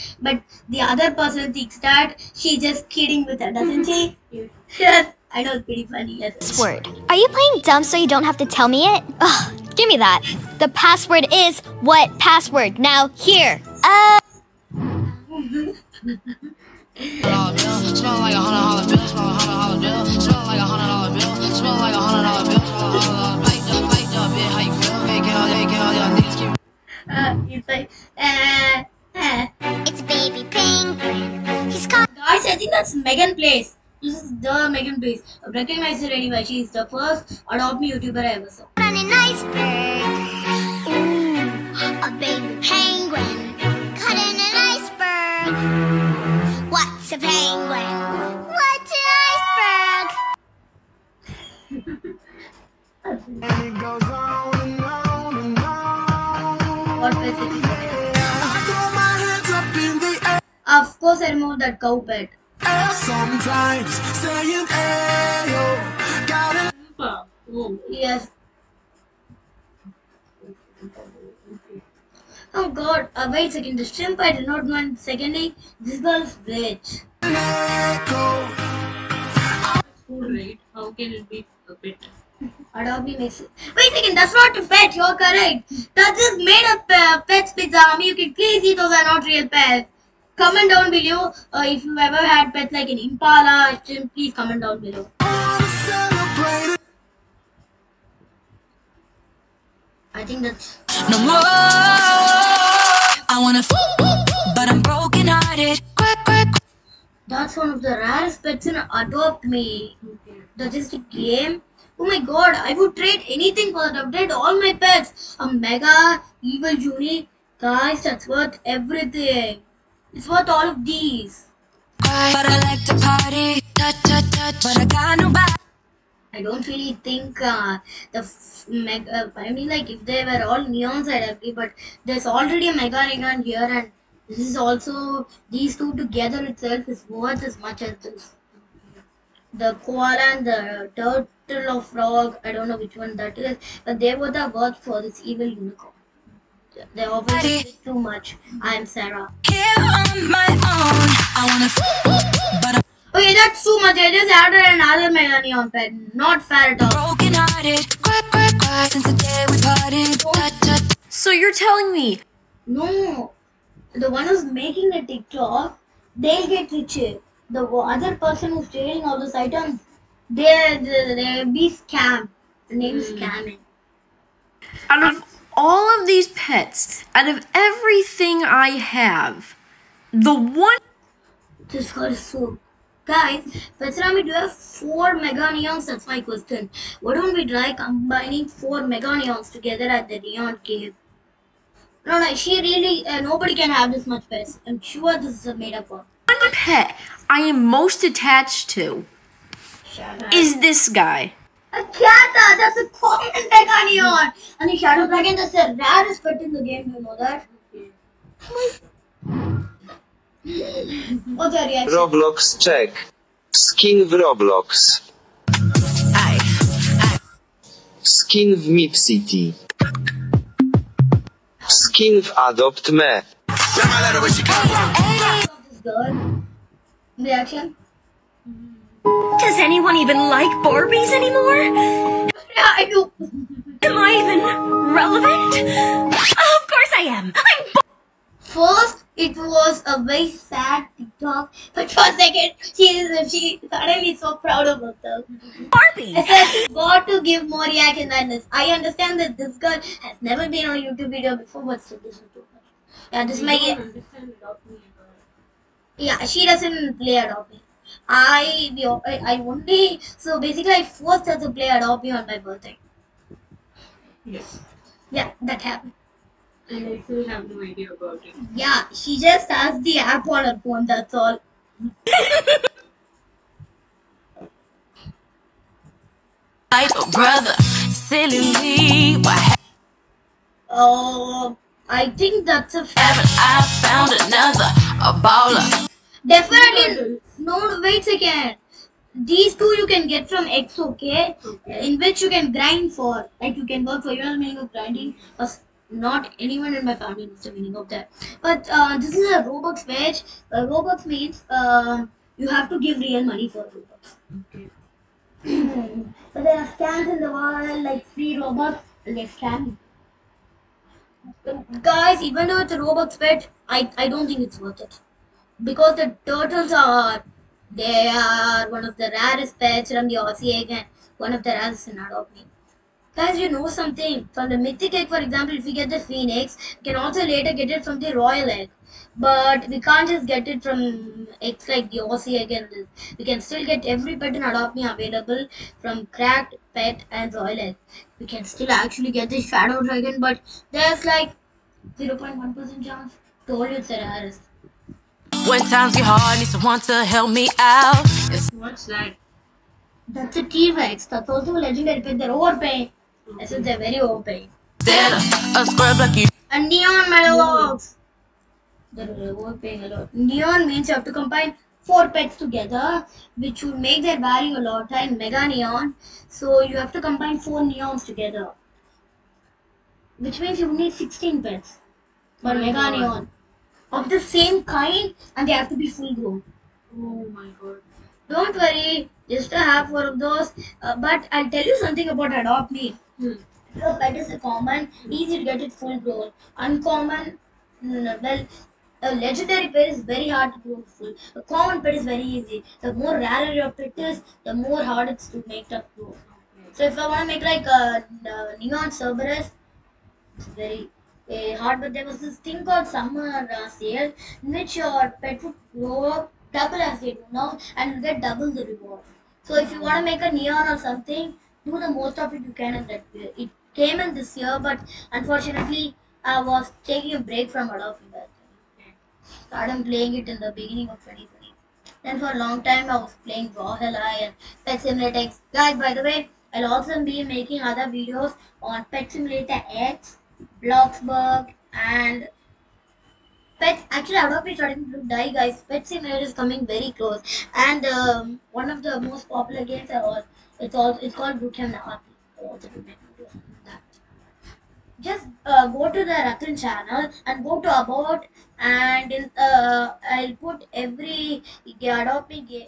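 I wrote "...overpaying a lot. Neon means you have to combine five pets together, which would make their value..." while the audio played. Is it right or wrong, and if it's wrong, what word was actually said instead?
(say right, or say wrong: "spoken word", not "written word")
wrong: "four", not "five".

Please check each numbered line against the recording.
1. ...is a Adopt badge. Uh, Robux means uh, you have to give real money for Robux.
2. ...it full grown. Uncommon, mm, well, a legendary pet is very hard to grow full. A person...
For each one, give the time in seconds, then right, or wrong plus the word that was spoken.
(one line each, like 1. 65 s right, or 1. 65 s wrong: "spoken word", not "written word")
1. 299 s wrong: "Robux", not "Adopt"
2. 385 s wrong: "common", not "person".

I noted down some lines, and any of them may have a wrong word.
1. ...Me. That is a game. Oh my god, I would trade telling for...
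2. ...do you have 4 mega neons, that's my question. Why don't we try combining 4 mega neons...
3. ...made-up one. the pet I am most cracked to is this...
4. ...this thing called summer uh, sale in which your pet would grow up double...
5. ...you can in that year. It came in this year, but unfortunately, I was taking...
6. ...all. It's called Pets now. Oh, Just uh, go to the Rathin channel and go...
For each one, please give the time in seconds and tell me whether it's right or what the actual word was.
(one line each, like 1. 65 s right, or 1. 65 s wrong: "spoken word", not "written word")
1. 109 s wrong: "anything", not "telling"
2. 183 s right
3. 195 s wrong: "attached", not "cracked"
4. 402 s right
5. 412 s right
6. 440 s wrong: "Bootcamp", not "Pets".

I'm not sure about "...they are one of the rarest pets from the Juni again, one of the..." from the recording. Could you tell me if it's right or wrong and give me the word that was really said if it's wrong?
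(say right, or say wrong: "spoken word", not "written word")
wrong: "Aussie", not "Juni".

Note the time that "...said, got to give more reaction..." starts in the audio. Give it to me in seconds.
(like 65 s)
246 s.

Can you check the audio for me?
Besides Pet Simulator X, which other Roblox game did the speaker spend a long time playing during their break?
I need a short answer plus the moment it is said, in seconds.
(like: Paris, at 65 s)
Valhalla, at 423 s.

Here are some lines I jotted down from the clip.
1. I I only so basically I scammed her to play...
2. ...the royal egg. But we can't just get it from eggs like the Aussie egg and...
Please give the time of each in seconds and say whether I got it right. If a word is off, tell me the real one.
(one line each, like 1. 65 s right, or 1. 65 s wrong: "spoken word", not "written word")
1. 258 s wrong: "forced", not "scammed"
2. 327 s right.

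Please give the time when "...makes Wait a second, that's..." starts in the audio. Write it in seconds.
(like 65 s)
83 s.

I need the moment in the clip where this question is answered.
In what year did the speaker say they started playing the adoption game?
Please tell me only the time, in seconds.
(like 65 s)
420 s.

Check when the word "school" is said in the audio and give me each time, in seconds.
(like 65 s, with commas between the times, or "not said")
not said.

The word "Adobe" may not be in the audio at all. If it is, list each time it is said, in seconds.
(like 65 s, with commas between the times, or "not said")
82 s, 417 s.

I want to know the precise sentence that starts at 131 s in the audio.
But there's already a mega neon here, and this is also these two together itself is worth as much as this.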